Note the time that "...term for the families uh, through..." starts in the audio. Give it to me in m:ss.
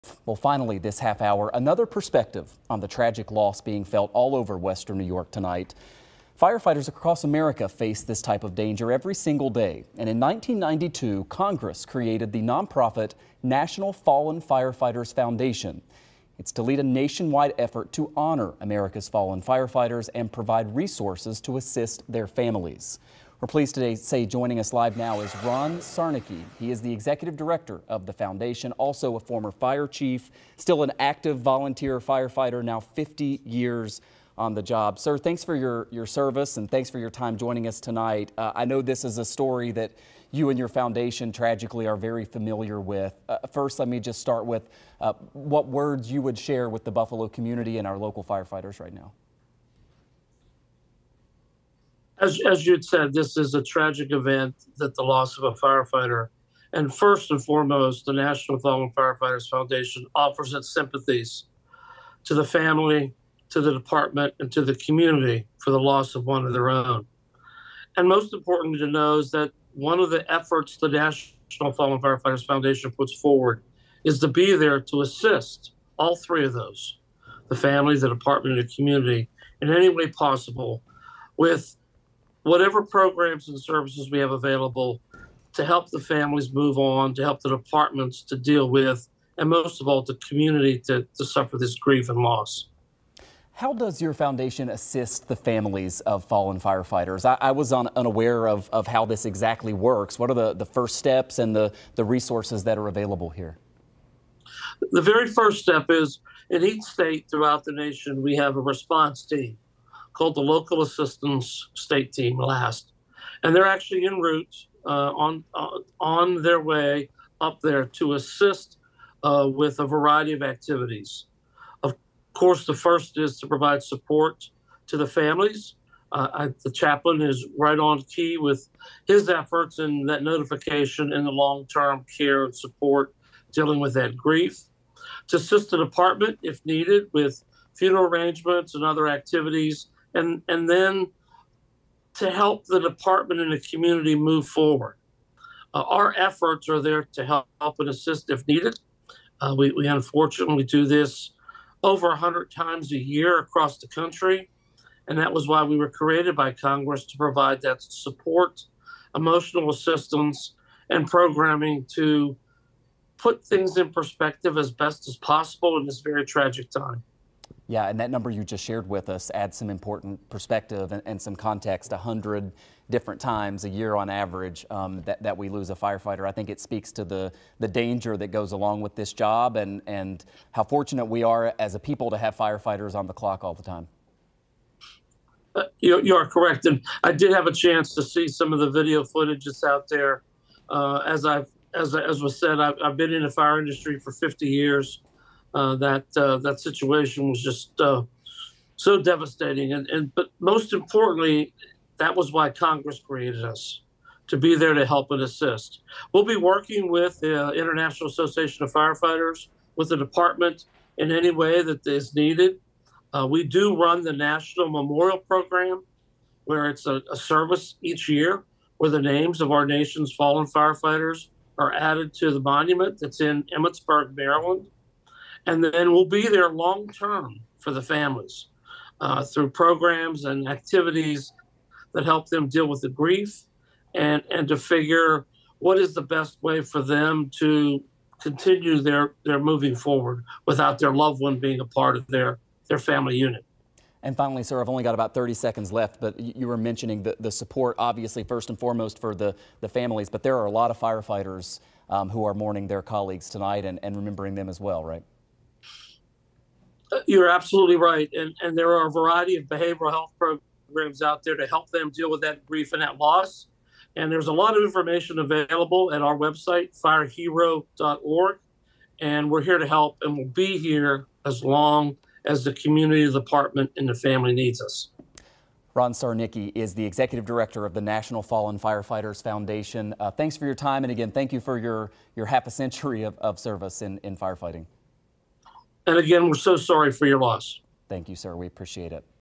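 3:46.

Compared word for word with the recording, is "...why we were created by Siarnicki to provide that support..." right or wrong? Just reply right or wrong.
wrong.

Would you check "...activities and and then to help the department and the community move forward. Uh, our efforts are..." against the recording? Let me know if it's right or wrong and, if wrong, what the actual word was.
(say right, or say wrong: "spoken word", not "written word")
right.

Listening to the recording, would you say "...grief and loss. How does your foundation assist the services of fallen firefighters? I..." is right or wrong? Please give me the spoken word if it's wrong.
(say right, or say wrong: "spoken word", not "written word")
wrong: "families", not "services".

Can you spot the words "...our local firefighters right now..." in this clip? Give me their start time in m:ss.
0:47.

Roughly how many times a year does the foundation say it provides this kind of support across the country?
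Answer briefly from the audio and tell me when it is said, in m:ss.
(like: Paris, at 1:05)
over 100, at 2:31.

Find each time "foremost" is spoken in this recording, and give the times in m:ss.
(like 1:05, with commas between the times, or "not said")
0:57, 4:08.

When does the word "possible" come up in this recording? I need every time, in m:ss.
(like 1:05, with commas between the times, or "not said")
1:20, 2:45.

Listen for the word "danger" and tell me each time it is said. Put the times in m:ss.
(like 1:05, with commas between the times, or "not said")
0:08, 2:57.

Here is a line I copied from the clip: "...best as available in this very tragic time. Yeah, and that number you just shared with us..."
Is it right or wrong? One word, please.
wrong.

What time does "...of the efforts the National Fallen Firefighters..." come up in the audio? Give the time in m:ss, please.
1:09.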